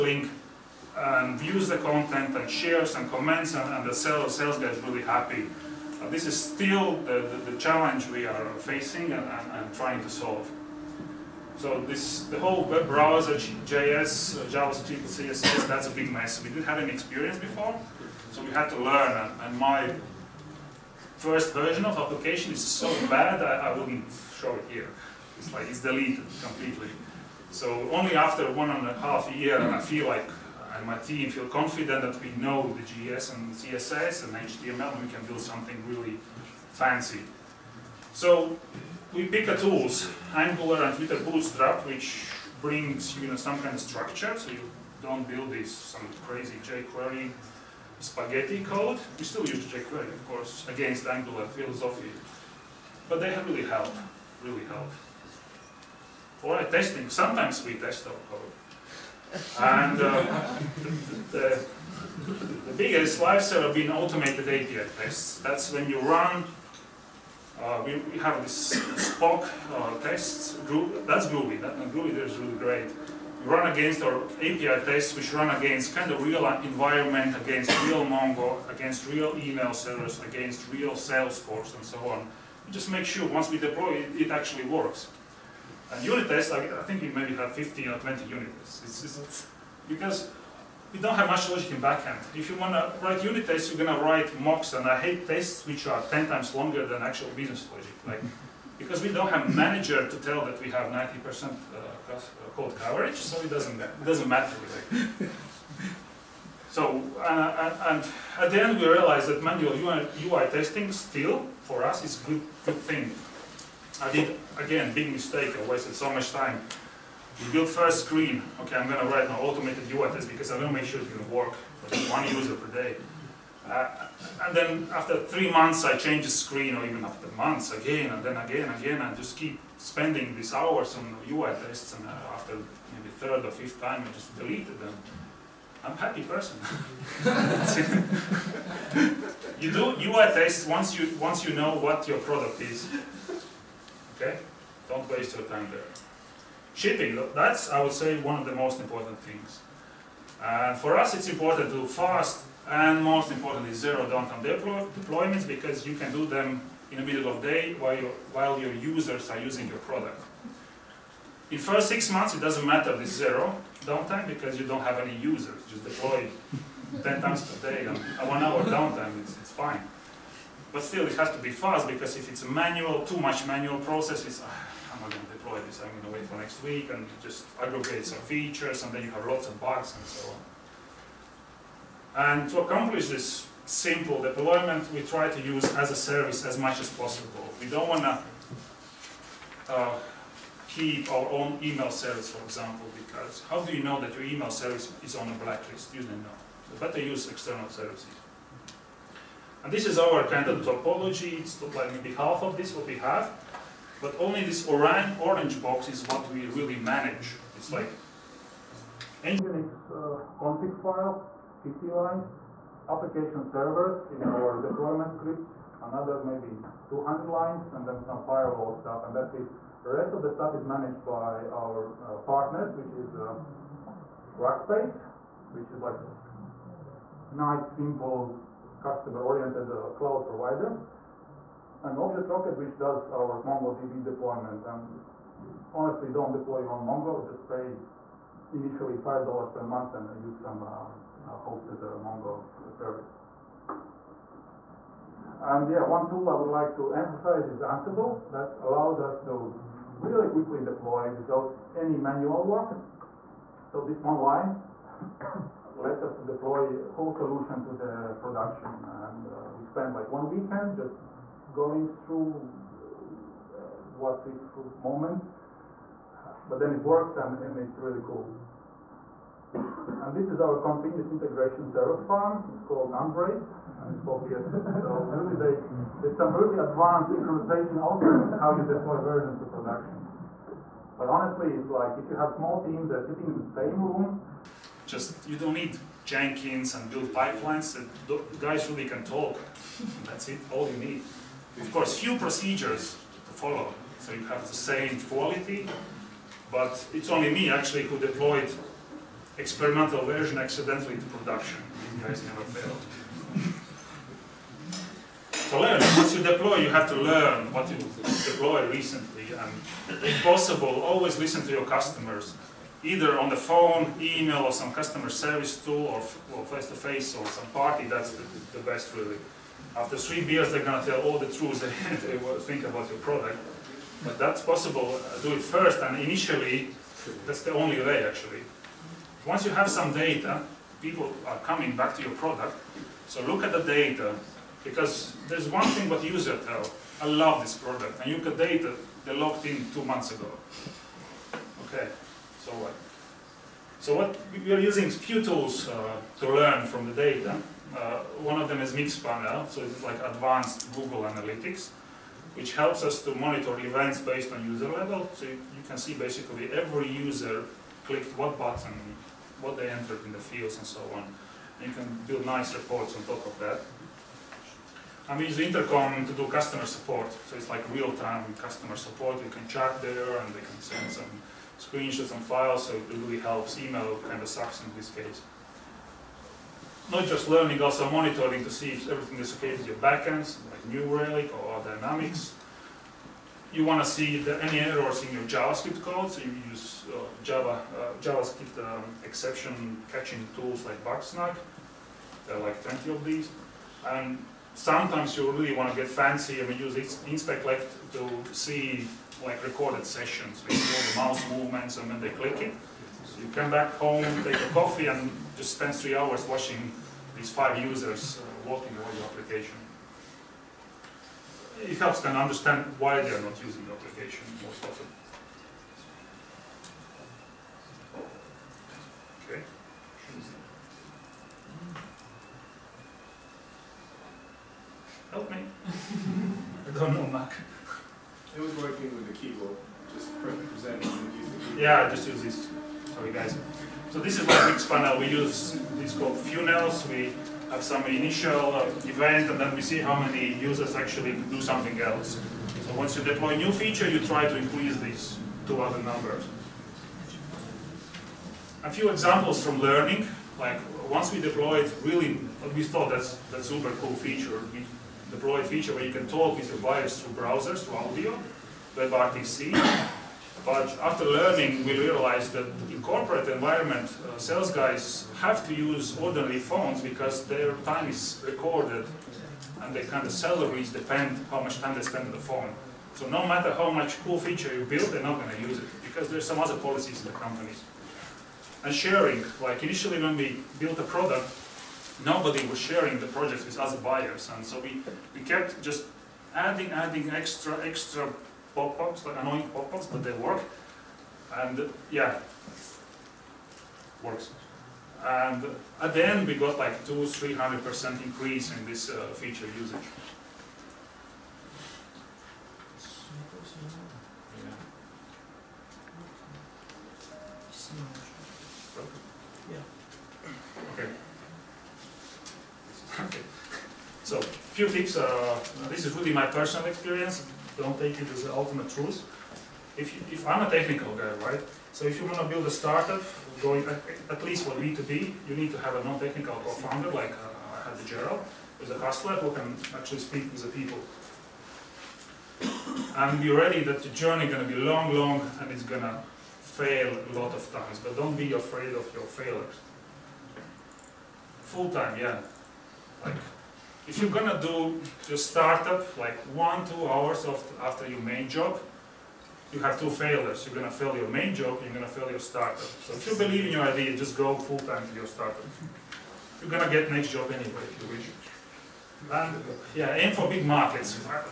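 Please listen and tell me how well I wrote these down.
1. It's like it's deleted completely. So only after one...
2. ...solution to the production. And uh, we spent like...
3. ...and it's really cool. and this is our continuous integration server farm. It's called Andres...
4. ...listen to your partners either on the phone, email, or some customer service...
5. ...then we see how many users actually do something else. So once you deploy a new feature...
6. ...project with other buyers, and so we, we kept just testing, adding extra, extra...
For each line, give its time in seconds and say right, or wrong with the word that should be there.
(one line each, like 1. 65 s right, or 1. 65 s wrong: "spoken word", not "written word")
1. 25 s right
2. 257 s right
3. 267 s right
4. 311 s wrong: "customers", not "partners"
5. 439 s right
6. 483 s wrong: "adding", not "testing".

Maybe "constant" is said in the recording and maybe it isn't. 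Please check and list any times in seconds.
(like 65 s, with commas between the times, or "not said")
not said.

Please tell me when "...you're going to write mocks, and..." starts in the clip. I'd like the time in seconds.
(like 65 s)
93 s.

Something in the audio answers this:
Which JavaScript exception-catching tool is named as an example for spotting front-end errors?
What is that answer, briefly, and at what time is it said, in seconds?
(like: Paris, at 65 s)
Bugsnag, at 390 s.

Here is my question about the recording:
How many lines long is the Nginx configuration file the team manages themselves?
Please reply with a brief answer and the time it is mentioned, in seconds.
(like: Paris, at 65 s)
50, at 211 s.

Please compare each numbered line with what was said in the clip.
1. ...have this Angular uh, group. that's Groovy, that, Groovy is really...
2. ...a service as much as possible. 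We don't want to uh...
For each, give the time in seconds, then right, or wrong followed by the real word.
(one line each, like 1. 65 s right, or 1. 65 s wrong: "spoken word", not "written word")
1. 68 s wrong: "Spock", not "Angular"
2. 185 s right.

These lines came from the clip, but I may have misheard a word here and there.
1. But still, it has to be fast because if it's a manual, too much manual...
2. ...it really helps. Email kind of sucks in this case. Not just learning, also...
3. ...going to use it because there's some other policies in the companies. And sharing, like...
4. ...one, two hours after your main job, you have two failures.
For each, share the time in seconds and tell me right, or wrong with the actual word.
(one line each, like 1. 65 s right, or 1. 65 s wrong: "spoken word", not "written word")
1. 170 s right
2. 372 s right
3. 475 s right
4. 546 s right.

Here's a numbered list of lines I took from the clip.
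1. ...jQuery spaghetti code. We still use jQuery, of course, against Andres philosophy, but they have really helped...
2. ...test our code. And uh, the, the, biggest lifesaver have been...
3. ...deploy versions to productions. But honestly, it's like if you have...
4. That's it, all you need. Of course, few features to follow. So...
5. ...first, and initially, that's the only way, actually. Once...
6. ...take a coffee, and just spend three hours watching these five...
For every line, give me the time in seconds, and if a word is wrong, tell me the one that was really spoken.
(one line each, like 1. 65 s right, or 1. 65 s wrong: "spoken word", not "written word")
1. 46 s wrong: "Angular", not "Andres"
2. 57 s right
3. 278 s right
4. 290 s wrong: "procedures", not "features"
5. 325 s right
6. 404 s right.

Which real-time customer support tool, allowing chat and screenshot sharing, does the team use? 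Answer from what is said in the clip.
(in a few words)
Intercom.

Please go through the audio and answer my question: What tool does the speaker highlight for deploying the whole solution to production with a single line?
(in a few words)
Ansible.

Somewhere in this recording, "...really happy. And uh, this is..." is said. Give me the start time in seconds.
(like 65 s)
4 s.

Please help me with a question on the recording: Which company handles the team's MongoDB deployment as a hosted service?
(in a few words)
Object Rocket.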